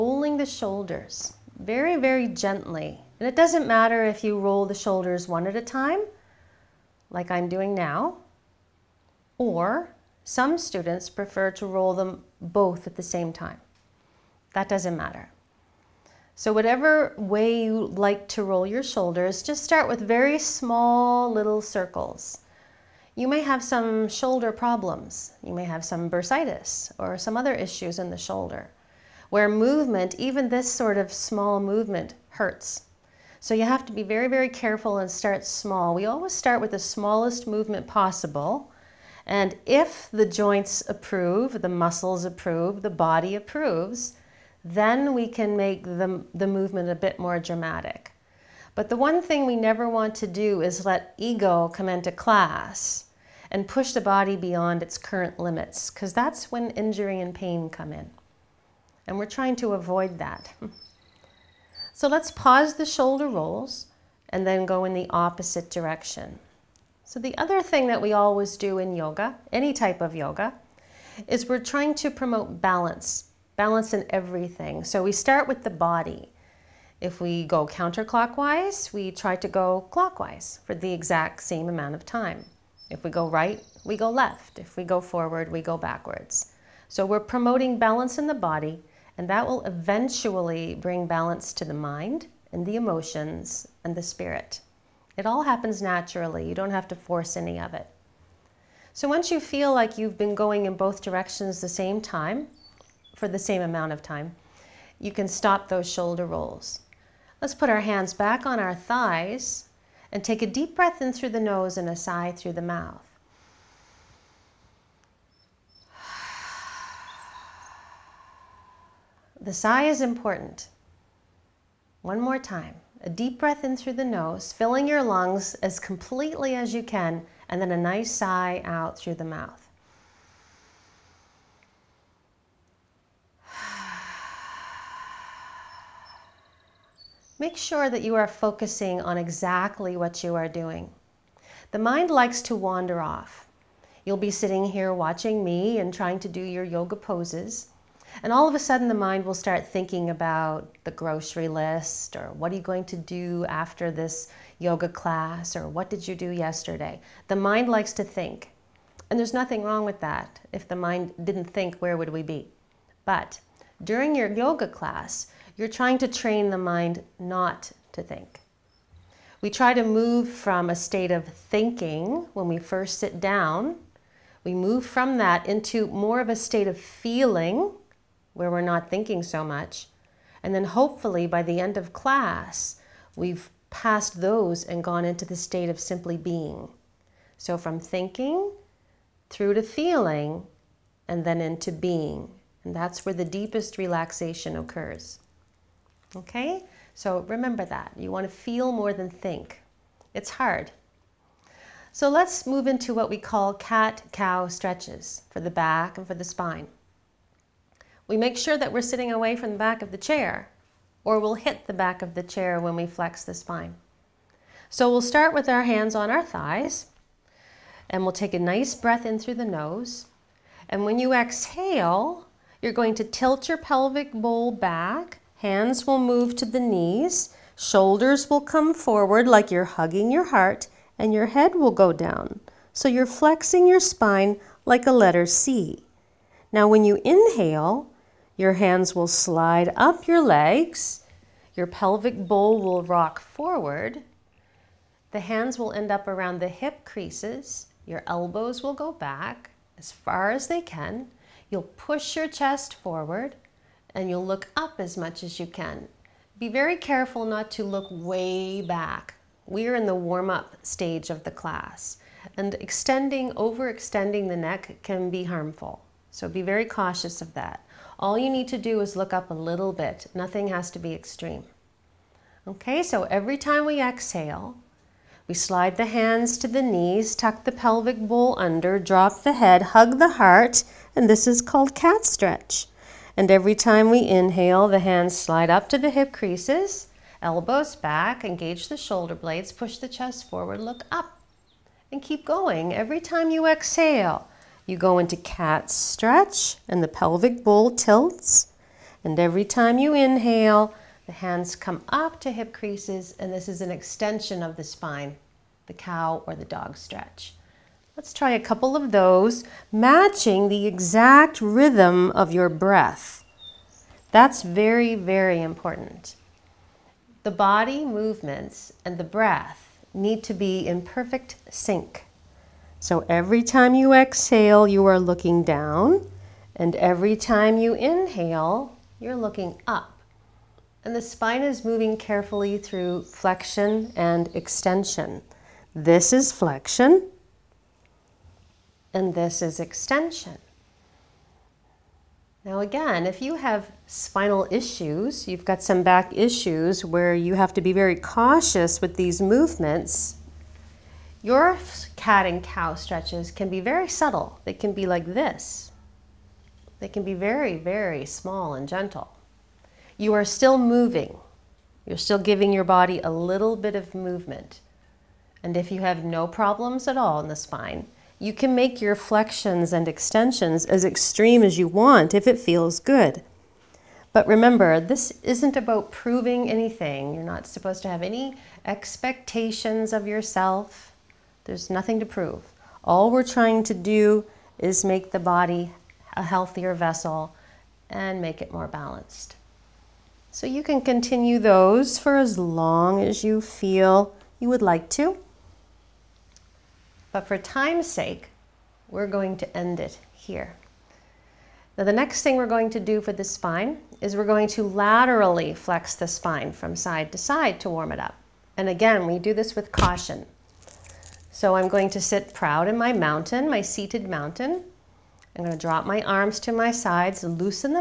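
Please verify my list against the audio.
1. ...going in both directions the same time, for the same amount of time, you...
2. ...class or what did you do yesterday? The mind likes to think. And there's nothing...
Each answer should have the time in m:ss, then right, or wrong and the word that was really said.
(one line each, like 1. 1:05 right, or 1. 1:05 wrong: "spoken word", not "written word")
1. 1:40 right
2. 2:34 right.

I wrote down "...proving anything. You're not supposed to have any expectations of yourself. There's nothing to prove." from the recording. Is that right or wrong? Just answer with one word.
right.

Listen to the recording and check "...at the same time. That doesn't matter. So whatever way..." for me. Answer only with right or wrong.
right.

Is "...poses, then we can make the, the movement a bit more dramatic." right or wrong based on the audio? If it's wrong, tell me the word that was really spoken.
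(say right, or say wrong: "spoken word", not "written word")
wrong: "approves", not "poses".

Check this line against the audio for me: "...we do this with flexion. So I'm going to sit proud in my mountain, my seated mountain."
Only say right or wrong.
wrong.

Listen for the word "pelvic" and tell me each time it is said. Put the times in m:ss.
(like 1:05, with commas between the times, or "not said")
3:43, 4:01, 4:37, 4:56.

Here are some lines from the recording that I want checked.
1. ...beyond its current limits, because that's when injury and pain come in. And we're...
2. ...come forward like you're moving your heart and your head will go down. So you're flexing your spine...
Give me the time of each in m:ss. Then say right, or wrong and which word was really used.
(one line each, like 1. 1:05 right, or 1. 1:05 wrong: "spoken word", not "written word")
1. 0:54 right
2. 3:48 wrong: "hugging", not "moving".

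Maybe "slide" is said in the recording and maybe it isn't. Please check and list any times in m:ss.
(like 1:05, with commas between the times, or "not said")
3:59, 4:35, 4:45.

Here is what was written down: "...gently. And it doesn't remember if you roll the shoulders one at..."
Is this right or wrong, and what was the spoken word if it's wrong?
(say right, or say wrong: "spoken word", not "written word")
wrong: "matter", not "remember".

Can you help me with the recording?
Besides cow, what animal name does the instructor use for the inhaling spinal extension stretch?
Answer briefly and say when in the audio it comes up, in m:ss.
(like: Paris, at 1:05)
dog, at 5:06.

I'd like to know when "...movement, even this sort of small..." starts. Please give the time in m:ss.
0:29.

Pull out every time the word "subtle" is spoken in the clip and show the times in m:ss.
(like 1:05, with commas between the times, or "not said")
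5:53.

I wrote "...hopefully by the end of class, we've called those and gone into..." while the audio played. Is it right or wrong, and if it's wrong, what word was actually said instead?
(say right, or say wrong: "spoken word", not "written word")
wrong: "passed", not "called".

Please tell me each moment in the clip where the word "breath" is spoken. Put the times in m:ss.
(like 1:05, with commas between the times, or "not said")
1:50, 2:03, 3:38, 5:12, 5:19.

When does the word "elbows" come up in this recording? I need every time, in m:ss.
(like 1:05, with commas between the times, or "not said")
4:08, 4:47.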